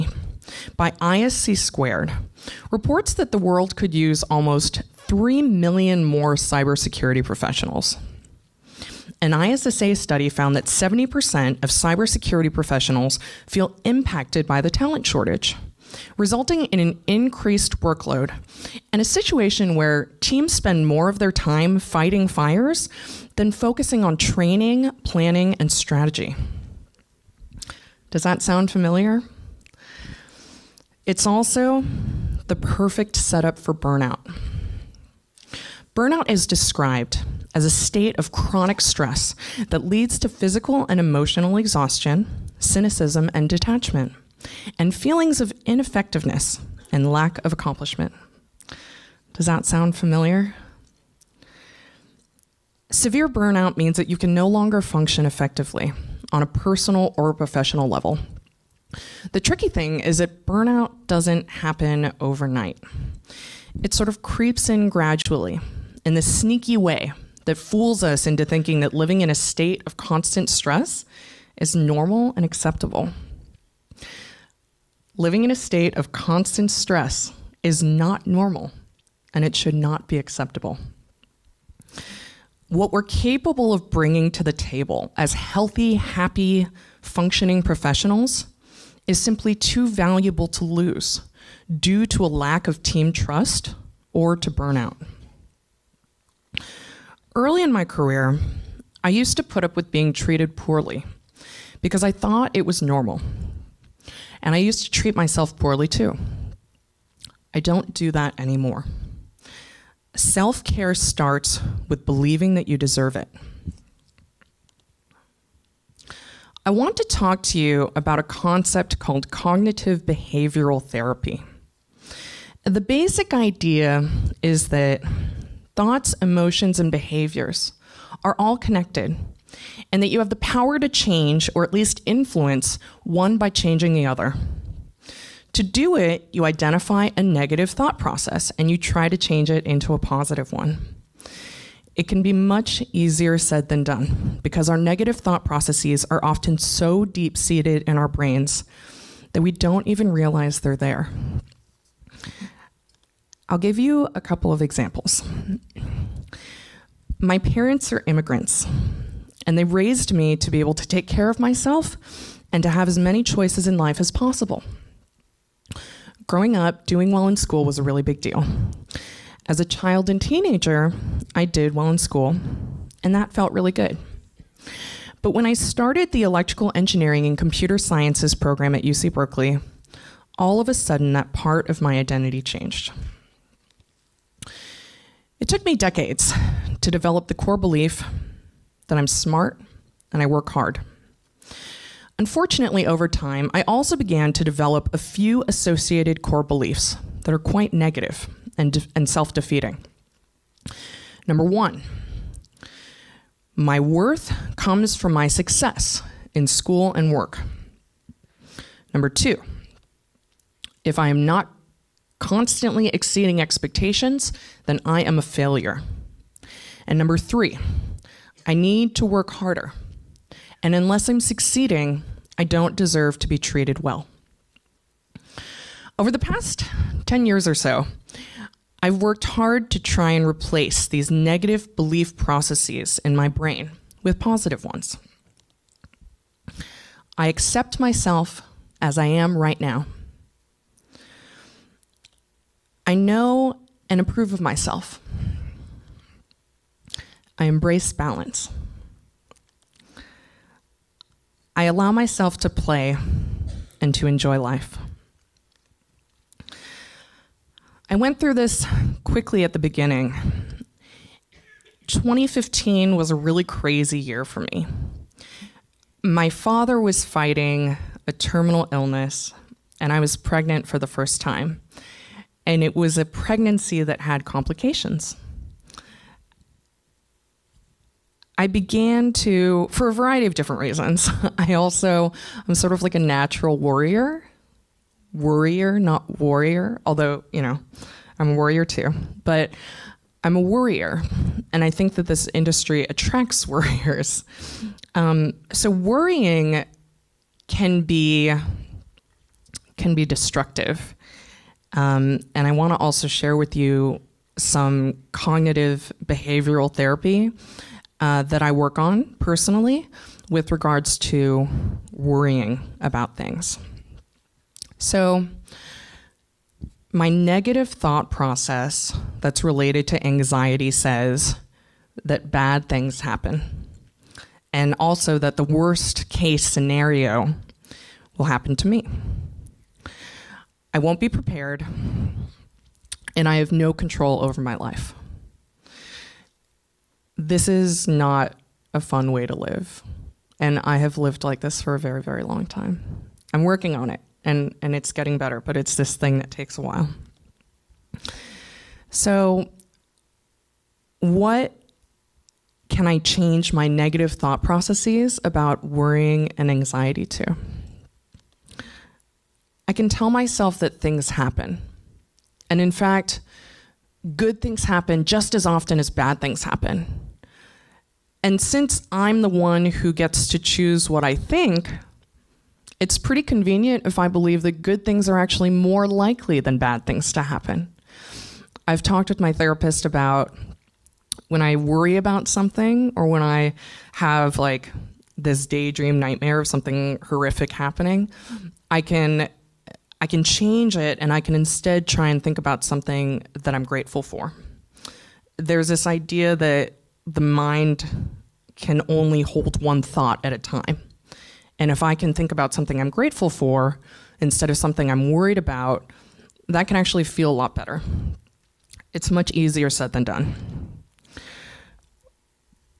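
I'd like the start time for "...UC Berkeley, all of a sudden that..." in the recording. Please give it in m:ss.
2:58.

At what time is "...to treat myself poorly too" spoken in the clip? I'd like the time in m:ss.
1:44.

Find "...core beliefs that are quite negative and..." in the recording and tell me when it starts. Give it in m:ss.
3:16.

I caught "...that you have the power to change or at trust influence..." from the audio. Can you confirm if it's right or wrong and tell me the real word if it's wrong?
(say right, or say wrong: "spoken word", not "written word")
wrong: "least", not "trust".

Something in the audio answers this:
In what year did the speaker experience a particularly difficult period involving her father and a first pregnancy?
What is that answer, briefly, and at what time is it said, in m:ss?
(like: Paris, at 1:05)
2015, at 4:21.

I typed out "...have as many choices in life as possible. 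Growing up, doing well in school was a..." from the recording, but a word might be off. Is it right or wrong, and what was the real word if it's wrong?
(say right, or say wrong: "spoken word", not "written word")
right.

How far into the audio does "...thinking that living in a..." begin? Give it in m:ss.
1:08.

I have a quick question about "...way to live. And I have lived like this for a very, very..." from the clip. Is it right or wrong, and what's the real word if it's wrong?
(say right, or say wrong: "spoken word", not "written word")
right.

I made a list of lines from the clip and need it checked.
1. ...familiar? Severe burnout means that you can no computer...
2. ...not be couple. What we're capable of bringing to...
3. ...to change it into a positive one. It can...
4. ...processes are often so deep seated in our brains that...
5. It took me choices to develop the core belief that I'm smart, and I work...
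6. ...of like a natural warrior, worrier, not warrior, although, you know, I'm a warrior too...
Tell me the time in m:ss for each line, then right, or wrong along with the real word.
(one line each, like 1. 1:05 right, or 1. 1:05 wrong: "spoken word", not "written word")
1. 0:49 wrong: "longer", not "computer"
2. 1:19 wrong: "acceptable", not "couple"
3. 2:19 right
4. 2:25 right
5. 3:05 wrong: "decades", not "choices"
6. 4:42 right.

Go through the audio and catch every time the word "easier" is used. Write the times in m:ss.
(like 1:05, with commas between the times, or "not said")
2:22, 6:49.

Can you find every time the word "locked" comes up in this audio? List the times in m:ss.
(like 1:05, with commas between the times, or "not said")
not said.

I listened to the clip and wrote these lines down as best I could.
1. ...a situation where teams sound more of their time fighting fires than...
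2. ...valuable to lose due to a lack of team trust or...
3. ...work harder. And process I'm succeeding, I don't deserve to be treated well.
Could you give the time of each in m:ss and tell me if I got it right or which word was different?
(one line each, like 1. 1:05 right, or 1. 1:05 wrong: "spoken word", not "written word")
1. 0:19 wrong: "spend", not "sound"
2. 1:29 right
3. 3:39 wrong: "unless", not "process".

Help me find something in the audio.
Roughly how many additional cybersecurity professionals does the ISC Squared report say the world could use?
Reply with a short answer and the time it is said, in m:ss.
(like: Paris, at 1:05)
Almost 3 million, at 0:04.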